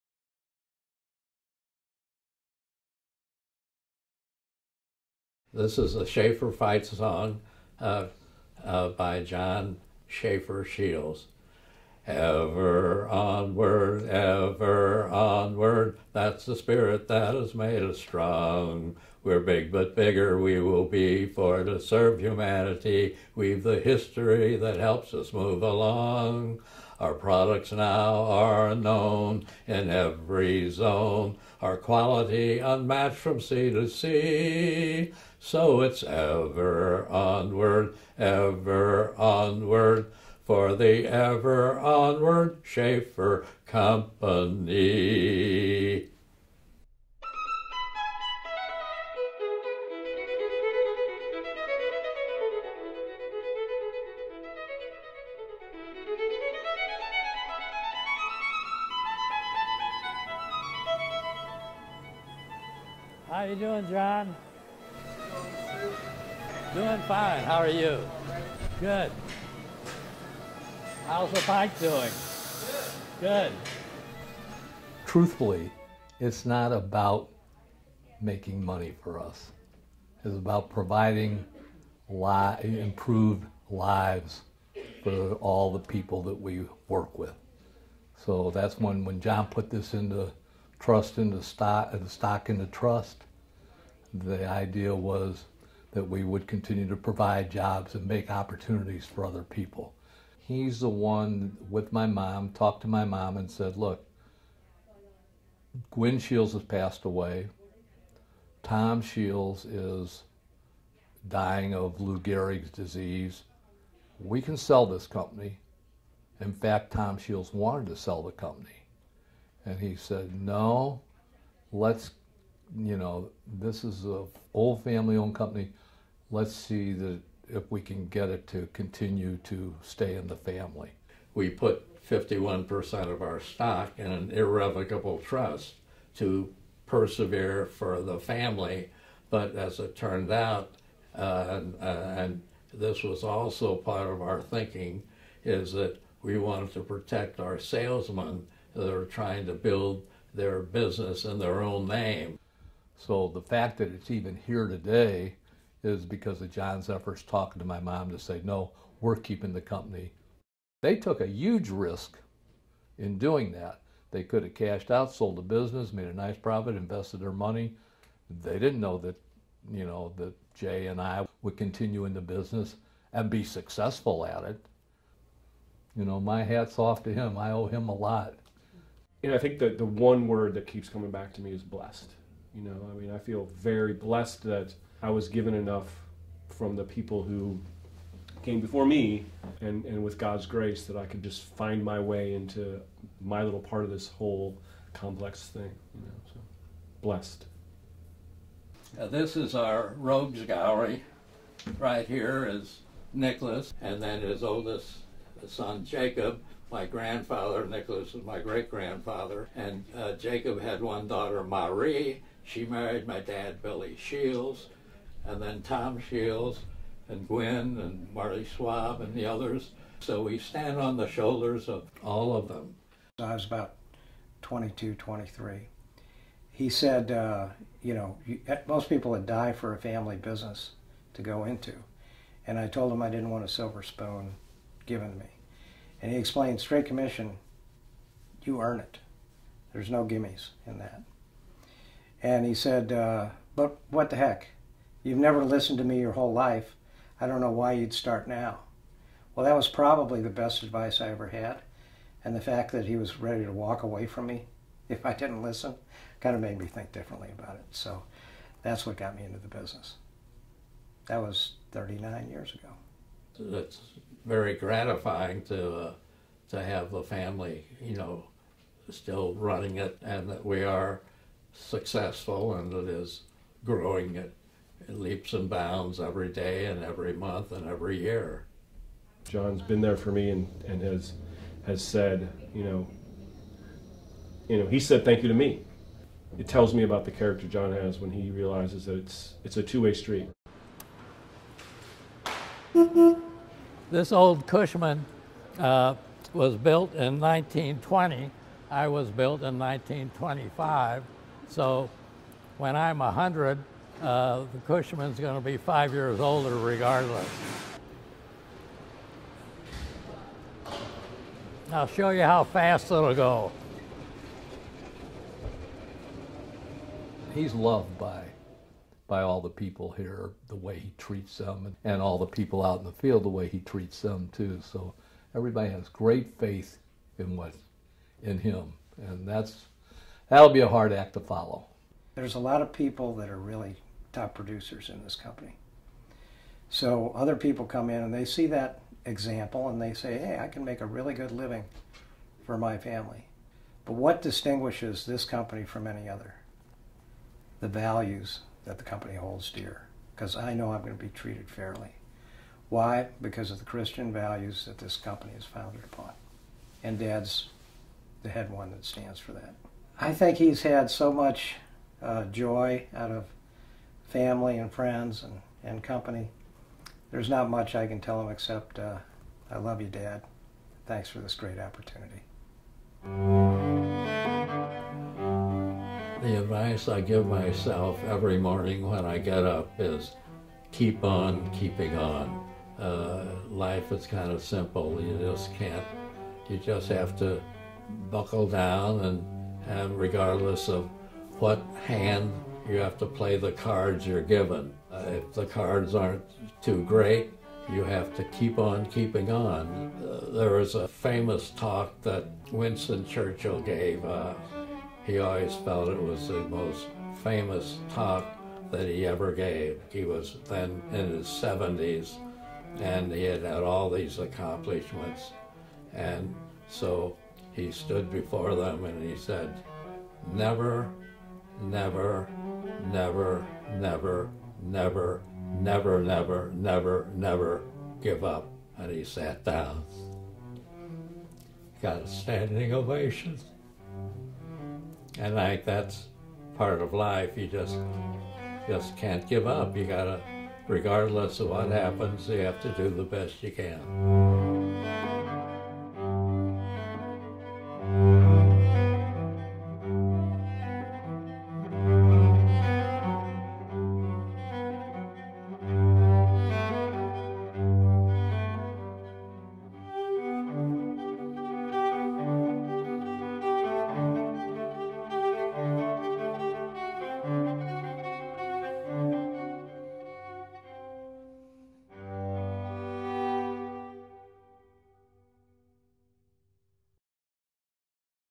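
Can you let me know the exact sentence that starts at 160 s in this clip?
They took a huge risk in doing that.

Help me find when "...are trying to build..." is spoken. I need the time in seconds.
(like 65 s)
148 s.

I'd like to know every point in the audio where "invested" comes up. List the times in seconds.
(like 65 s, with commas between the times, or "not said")
166 s.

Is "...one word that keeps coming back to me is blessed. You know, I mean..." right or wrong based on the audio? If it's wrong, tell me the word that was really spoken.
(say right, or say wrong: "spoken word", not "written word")
right.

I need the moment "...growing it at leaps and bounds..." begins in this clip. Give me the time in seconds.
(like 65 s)
273 s.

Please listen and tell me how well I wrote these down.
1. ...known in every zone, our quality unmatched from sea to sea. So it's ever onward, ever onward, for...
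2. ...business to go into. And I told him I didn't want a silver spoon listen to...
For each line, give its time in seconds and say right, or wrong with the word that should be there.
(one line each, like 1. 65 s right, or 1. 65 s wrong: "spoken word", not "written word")
1. 28 s right
2. 230 s wrong: "given", not "listen".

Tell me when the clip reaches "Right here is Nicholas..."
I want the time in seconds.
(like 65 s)
201 s.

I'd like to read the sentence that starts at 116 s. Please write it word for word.
In fact, Tom Shields wanted to sell the company.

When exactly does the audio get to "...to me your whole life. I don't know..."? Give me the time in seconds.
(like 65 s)
245 s.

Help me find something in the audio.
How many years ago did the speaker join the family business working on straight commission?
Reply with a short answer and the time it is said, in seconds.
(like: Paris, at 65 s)
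39, at 261 s.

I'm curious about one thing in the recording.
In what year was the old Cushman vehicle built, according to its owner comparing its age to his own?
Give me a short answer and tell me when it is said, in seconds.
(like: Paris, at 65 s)
1920, at 297 s.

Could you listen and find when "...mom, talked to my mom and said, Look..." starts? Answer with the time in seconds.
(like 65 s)
102 s.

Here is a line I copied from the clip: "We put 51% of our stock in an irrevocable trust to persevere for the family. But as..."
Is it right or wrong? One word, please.
right.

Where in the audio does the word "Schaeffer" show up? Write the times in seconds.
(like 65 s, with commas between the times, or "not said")
6 s, 10 s, 42 s.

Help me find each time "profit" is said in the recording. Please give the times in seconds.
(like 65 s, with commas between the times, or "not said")
166 s.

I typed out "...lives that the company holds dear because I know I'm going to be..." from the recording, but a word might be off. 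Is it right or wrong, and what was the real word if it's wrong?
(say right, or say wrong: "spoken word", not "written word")
wrong: "values", not "lives".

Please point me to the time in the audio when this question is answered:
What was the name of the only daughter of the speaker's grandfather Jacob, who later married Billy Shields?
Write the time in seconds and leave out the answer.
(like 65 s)
211 s.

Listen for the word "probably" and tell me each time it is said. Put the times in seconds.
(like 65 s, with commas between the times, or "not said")
249 s.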